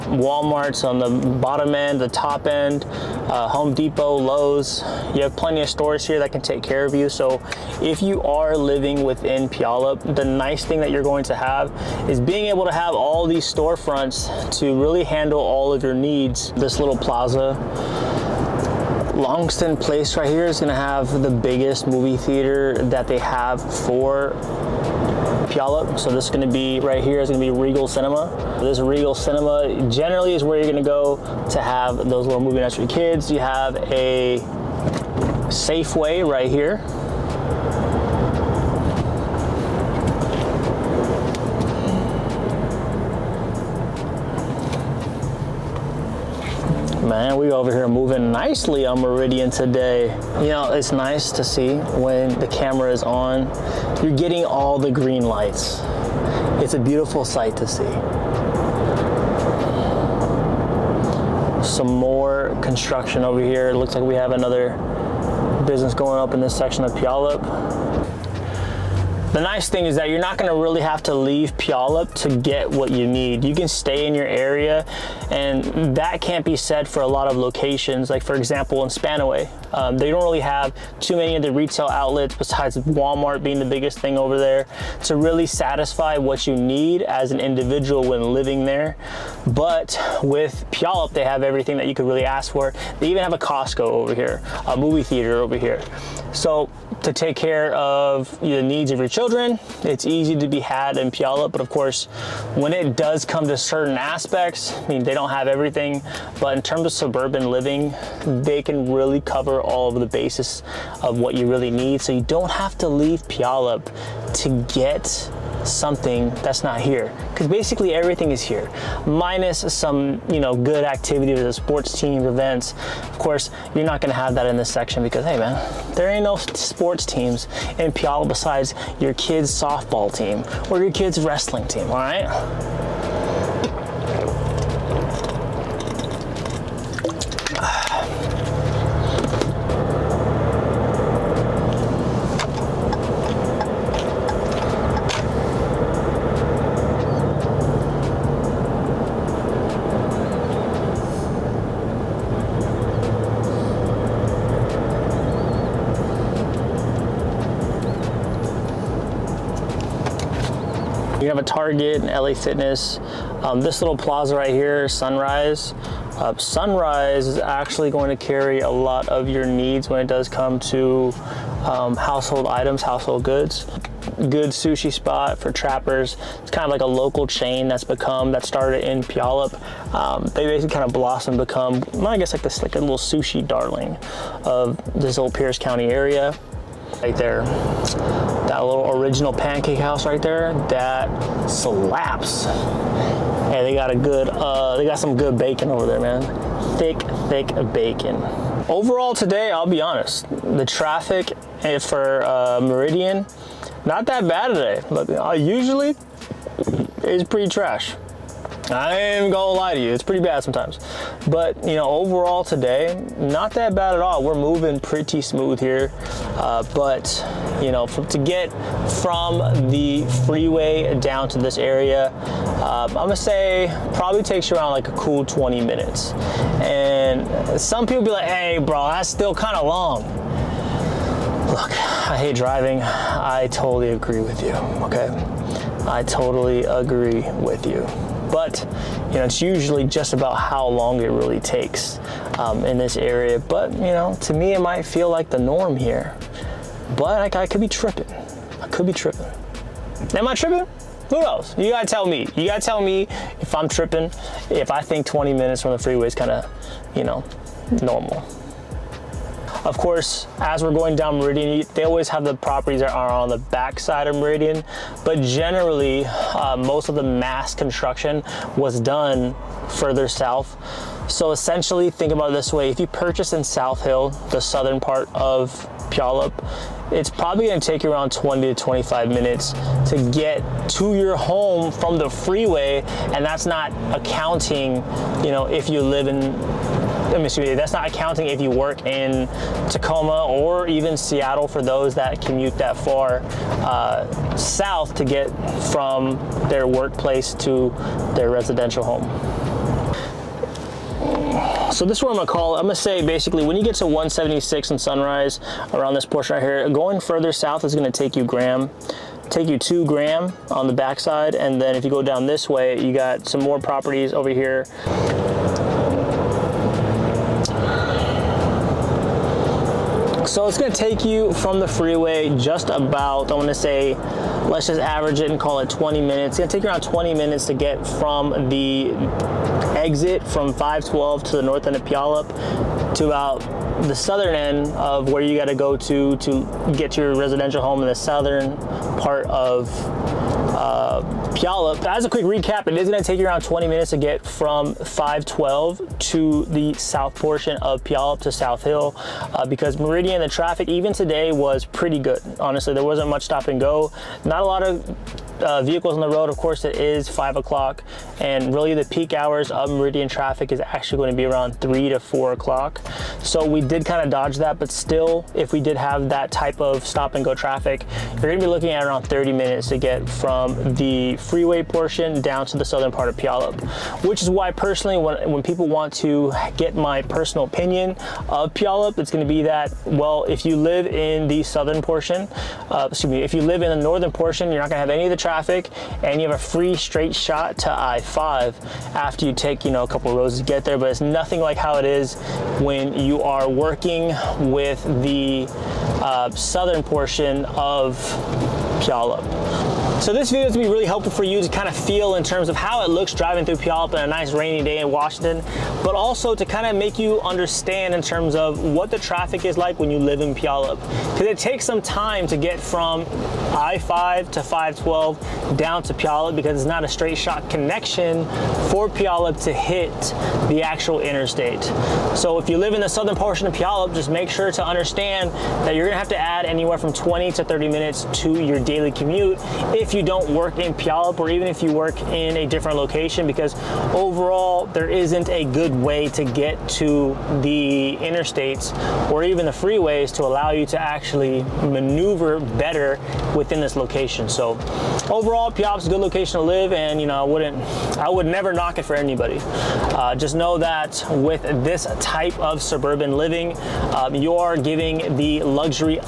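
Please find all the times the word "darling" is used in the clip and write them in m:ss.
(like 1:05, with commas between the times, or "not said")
3:03.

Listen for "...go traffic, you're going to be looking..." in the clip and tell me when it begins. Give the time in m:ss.
6:07.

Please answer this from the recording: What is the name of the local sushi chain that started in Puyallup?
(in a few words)
Trapper's.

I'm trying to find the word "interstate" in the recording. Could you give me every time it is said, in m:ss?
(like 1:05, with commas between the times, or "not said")
7:01, 7:18.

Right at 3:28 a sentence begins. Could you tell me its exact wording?
I ain't gonna lie to you, it's pretty bad sometimes.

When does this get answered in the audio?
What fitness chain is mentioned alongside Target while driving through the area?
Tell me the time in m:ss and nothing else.
2:42.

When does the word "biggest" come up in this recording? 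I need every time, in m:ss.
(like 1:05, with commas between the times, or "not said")
0:21, 1:23.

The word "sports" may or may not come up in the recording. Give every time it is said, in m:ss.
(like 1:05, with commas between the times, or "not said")
2:01, 2:06.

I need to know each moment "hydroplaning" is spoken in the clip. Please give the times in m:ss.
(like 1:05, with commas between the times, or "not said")
not said.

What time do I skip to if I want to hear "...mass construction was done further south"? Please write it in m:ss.
4:27.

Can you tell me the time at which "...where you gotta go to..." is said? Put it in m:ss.
5:35.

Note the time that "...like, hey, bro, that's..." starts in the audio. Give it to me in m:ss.
3:48.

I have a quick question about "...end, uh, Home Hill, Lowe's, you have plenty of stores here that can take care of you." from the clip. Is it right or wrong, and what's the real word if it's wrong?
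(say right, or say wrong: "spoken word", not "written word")
wrong: "Depot", not "Hill".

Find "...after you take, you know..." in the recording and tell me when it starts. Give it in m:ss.
6:28.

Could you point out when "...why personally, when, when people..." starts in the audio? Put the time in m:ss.
6:14.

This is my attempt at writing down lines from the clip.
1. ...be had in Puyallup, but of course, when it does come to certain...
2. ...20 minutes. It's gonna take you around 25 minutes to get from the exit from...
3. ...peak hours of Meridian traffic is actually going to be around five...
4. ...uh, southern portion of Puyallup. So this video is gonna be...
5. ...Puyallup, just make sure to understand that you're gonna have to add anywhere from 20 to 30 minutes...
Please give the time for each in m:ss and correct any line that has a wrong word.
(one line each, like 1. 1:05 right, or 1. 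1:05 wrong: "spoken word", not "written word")
1. 1:40 right
2. 5:25 wrong: "20", not "25"
3. 5:58 wrong: "three", not "five"
4. 6:36 right
5. 7:03 right.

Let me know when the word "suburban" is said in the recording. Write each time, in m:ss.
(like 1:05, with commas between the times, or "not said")
1:46, 7:32.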